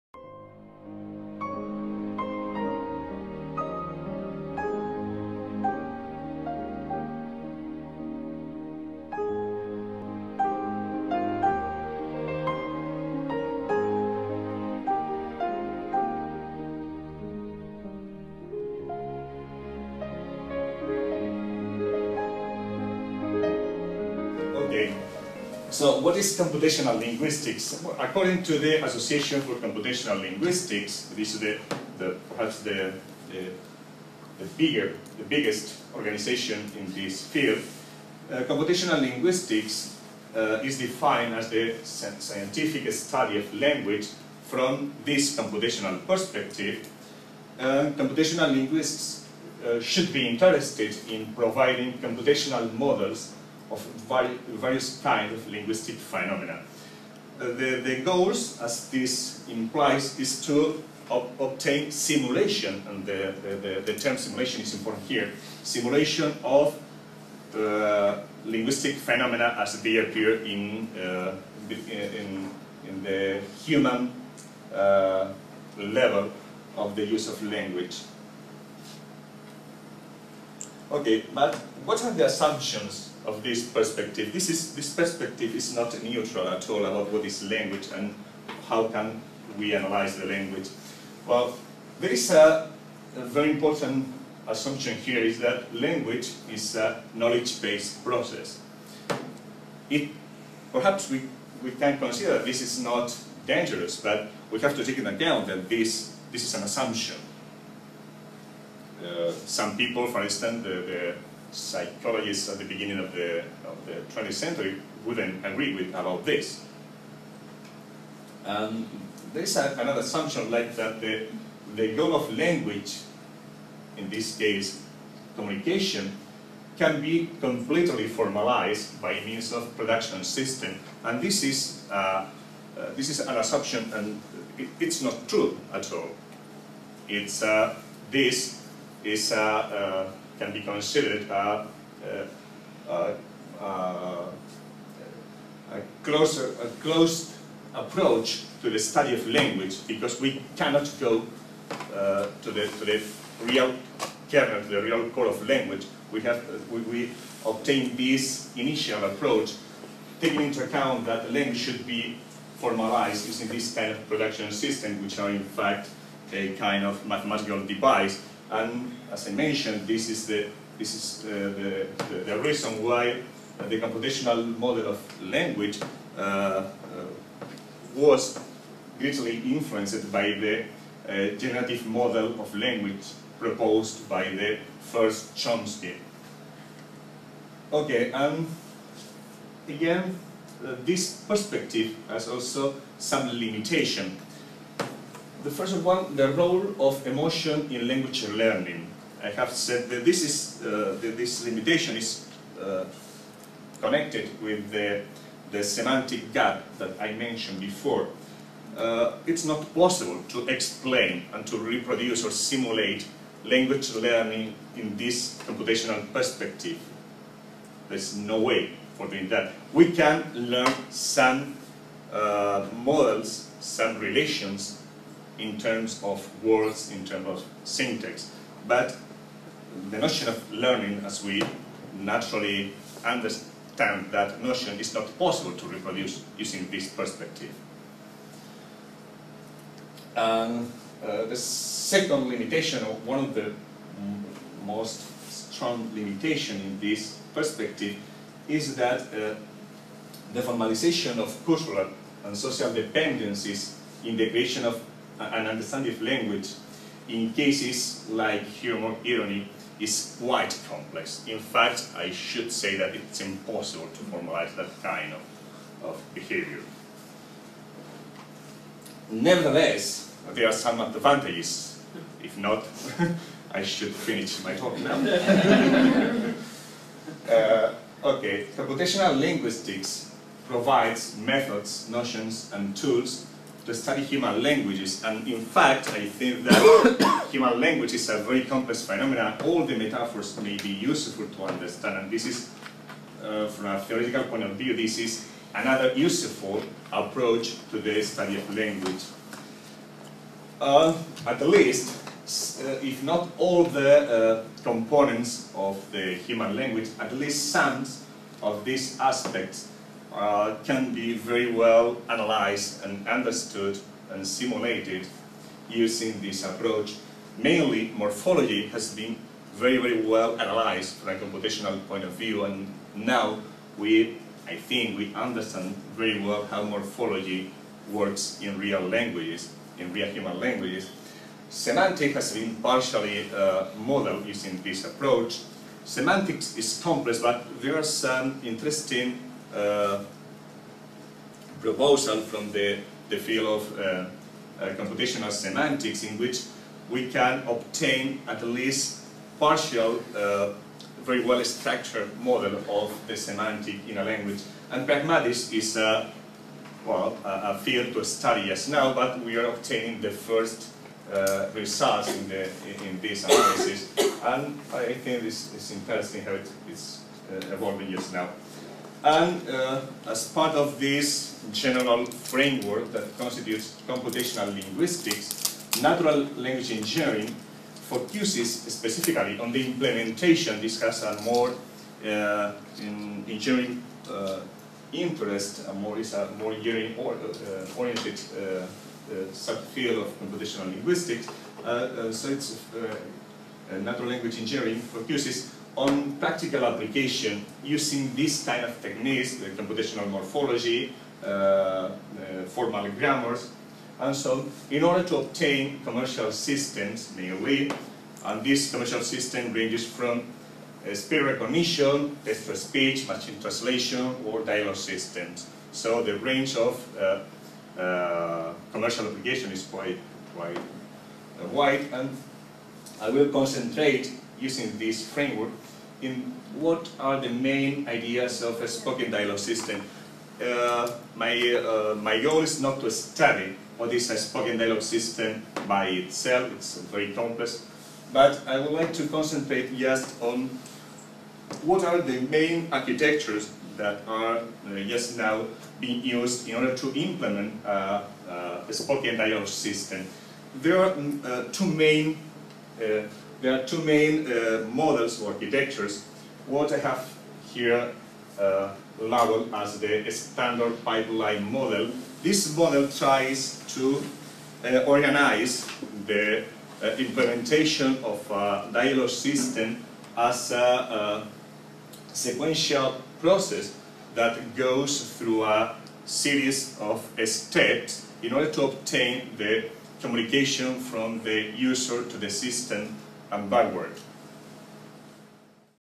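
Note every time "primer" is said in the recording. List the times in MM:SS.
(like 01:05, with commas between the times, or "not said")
not said.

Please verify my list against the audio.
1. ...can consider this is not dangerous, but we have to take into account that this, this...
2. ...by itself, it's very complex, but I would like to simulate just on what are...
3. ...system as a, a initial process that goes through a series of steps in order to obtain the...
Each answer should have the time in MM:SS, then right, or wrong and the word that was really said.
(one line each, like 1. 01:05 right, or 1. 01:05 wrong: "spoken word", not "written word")
1. 01:41 right
2. 07:15 wrong: "concentrate", not "simulate"
3. 07:49 wrong: "sequential", not "initial".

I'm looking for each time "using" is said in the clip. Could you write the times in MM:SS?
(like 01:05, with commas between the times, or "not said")
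02:43, 03:56, 05:15, 05:34, 06:37, 07:04.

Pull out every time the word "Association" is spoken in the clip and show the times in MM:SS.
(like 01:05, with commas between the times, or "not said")
00:28.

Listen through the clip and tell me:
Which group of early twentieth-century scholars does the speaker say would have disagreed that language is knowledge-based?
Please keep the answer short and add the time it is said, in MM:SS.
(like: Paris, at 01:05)
psychologists, at 01:51.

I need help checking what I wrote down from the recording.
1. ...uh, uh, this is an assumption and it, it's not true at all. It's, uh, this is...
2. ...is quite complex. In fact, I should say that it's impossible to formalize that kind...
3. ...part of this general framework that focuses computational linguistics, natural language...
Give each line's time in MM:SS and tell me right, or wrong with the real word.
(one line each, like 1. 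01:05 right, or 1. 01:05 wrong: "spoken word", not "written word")
1. 02:11 right
2. 04:19 right
3. 06:10 wrong: "constitutes", not "focuses".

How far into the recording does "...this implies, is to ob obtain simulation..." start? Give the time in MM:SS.
00:58.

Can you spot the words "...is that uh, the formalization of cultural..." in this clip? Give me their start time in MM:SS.
04:08.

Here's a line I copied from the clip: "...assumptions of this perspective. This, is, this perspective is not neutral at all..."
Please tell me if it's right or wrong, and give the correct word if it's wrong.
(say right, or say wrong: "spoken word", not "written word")
right.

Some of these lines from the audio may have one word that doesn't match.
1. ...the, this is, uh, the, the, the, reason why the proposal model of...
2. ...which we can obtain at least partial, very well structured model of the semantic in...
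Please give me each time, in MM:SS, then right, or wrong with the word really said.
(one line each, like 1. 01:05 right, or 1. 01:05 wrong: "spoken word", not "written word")
1. 02:50 wrong: "computational", not "proposal"
2. 05:46 right.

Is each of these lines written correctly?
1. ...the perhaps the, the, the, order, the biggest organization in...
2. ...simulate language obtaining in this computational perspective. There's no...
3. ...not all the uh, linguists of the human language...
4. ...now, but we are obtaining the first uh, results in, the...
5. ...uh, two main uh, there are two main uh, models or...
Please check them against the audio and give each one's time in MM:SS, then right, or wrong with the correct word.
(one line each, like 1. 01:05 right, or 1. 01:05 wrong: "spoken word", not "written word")
1. 00:31 wrong: "bigger", not "order"
2. 03:32 wrong: "learning", not "obtaining"
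3. 05:03 wrong: "components", not "linguists"
4. 05:58 right
5. 07:31 right.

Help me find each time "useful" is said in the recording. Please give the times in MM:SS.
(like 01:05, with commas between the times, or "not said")
04:50, 04:55.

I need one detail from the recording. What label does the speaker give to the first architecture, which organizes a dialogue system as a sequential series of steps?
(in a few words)
standard pipeline model.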